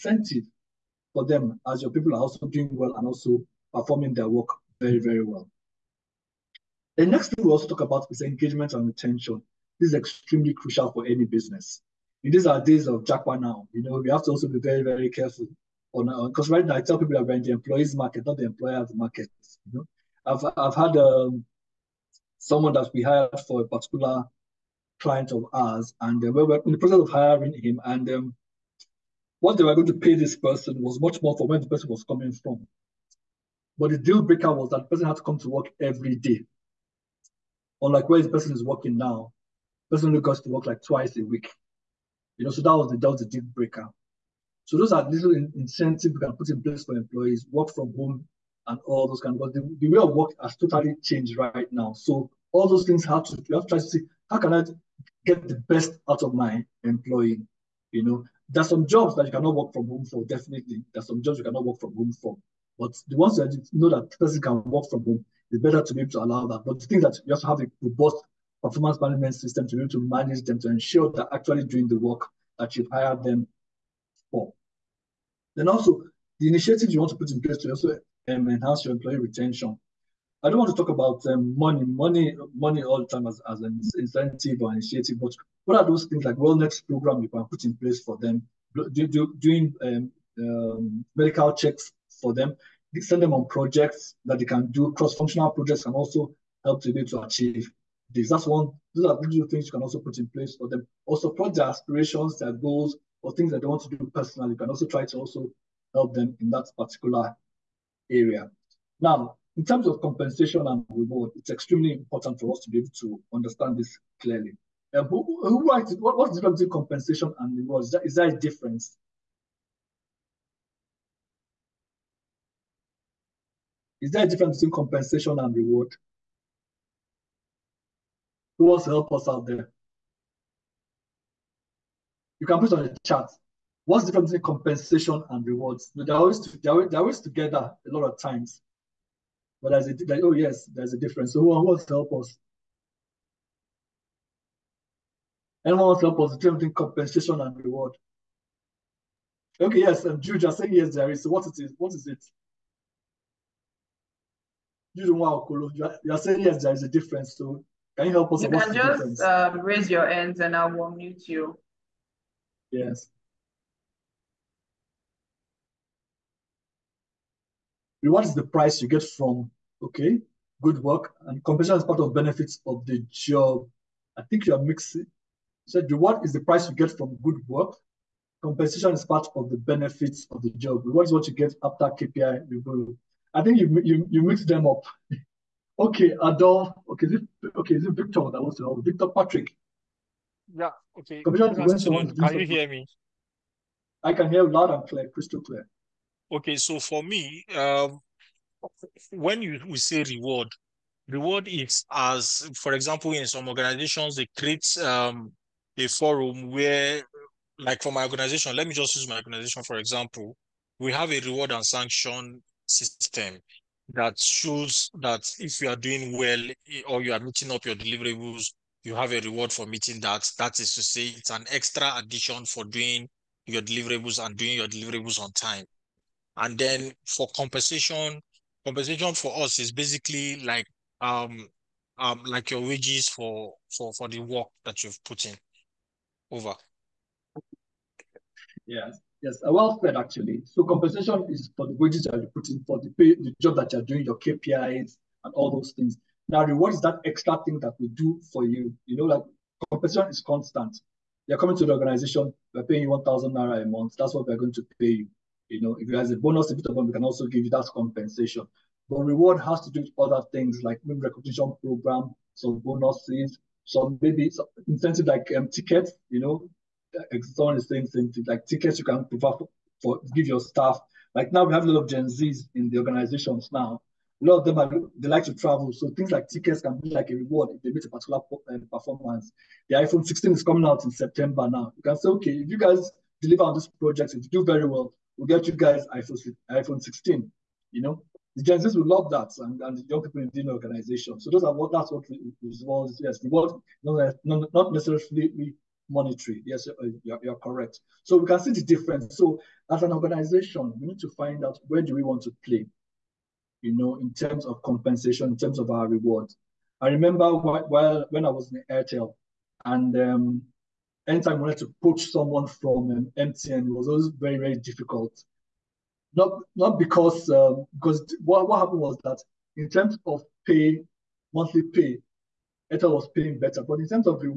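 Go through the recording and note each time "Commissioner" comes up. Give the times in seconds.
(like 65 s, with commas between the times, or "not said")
191 s.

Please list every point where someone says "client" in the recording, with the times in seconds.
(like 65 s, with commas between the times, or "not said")
24 s.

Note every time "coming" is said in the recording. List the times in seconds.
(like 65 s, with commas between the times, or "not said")
32 s, 251 s, 280 s.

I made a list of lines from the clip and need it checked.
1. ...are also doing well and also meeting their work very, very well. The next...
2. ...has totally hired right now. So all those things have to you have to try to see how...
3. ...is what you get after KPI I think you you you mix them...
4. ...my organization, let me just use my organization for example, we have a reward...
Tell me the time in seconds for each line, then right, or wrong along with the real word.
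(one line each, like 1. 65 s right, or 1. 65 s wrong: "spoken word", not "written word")
1. 2 s wrong: "performing", not "meeting"
2. 50 s wrong: "changed", not "hired"
3. 181 s right
4. 207 s right.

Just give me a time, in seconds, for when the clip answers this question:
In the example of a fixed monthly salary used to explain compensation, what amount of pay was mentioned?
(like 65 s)
252 s.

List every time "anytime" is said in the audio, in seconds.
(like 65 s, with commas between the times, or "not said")
311 s.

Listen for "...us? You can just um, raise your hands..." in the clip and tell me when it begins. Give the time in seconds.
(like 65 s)
158 s.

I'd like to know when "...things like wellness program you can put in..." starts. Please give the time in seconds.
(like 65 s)
86 s.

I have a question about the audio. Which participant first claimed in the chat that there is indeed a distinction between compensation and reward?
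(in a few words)
Jude.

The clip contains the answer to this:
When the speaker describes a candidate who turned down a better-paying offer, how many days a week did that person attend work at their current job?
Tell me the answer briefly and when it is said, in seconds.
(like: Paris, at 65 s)
2, at 40 s.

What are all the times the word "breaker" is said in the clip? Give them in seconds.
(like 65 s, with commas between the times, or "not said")
34 s, 43 s.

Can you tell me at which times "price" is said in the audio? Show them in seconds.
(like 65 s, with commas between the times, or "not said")
168 s, 176 s.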